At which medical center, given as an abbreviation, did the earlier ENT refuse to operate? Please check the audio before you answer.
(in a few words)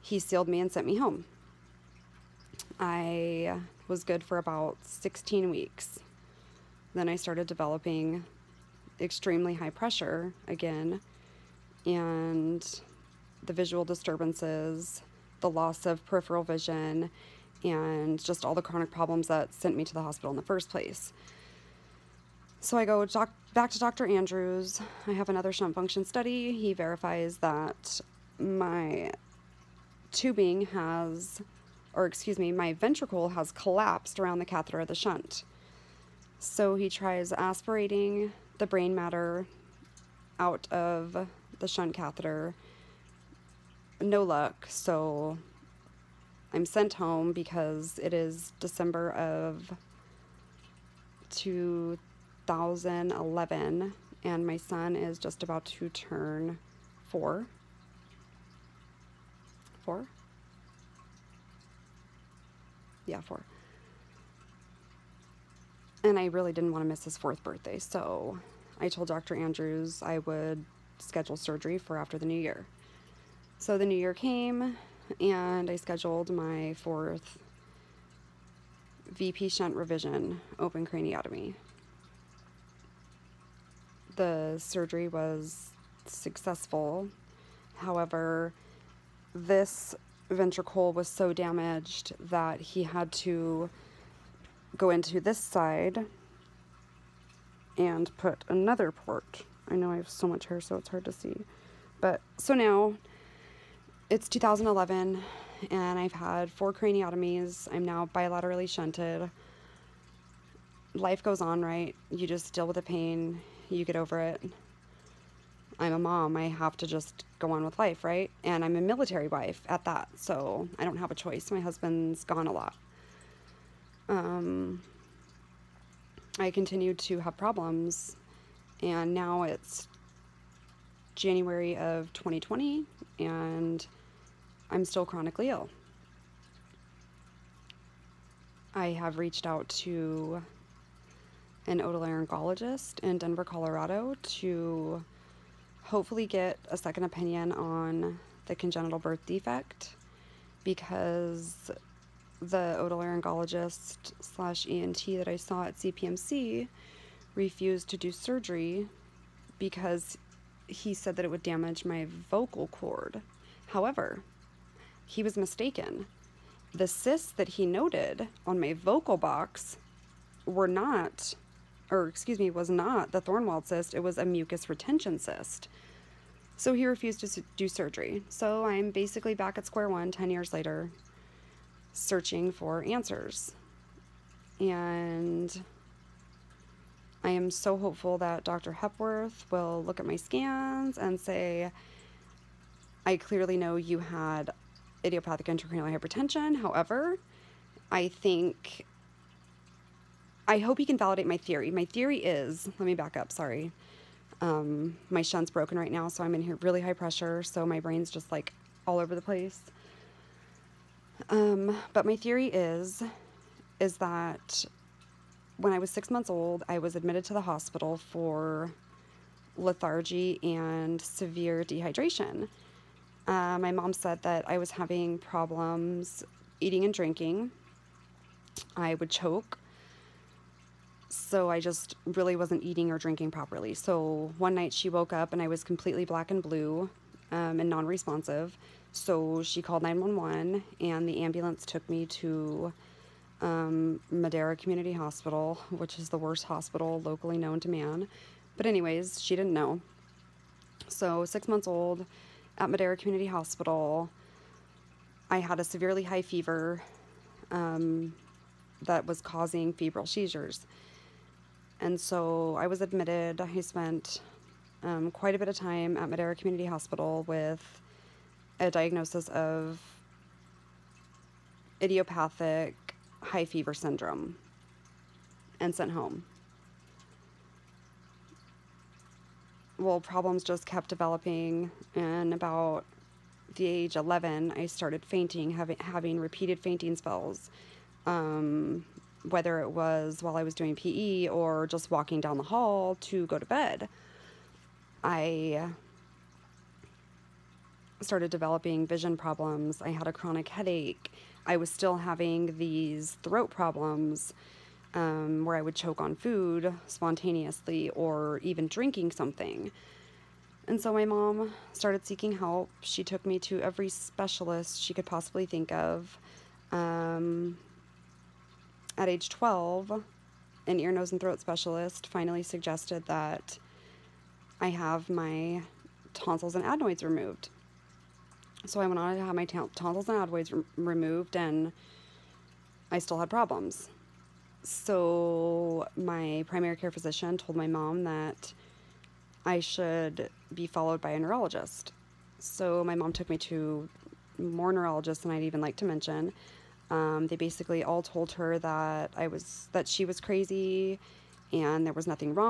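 CPMC.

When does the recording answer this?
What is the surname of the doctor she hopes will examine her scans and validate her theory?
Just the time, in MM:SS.
03:08.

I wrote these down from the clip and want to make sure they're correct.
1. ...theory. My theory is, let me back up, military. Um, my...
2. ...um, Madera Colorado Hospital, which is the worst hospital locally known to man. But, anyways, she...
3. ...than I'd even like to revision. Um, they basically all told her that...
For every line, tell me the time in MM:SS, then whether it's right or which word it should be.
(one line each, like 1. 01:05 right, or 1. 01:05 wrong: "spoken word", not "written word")
1. 03:21 wrong: "sorry", not "military"
2. 04:03 wrong: "Community", not "Colorado"
3. 05:45 wrong: "mention", not "revision".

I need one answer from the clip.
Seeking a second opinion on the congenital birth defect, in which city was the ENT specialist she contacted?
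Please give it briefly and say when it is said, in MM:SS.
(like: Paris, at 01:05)
Denver, at 02:23.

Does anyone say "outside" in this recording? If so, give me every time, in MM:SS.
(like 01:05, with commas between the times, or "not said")
not said.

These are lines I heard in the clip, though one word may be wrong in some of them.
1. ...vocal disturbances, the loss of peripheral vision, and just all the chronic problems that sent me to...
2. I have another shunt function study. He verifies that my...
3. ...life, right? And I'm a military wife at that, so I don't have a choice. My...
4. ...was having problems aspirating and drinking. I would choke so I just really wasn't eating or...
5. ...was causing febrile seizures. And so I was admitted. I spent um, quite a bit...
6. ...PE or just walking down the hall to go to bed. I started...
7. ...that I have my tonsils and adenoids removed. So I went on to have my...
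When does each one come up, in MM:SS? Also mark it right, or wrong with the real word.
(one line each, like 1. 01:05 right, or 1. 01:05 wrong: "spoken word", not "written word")
1. 00:13 wrong: "visual", not "vocal"
2. 00:25 right
3. 01:57 right
4. 03:44 wrong: "eating", not "aspirating"
5. 04:19 right
6. 04:50 right
7. 05:23 right.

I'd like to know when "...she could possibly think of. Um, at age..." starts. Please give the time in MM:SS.
05:14.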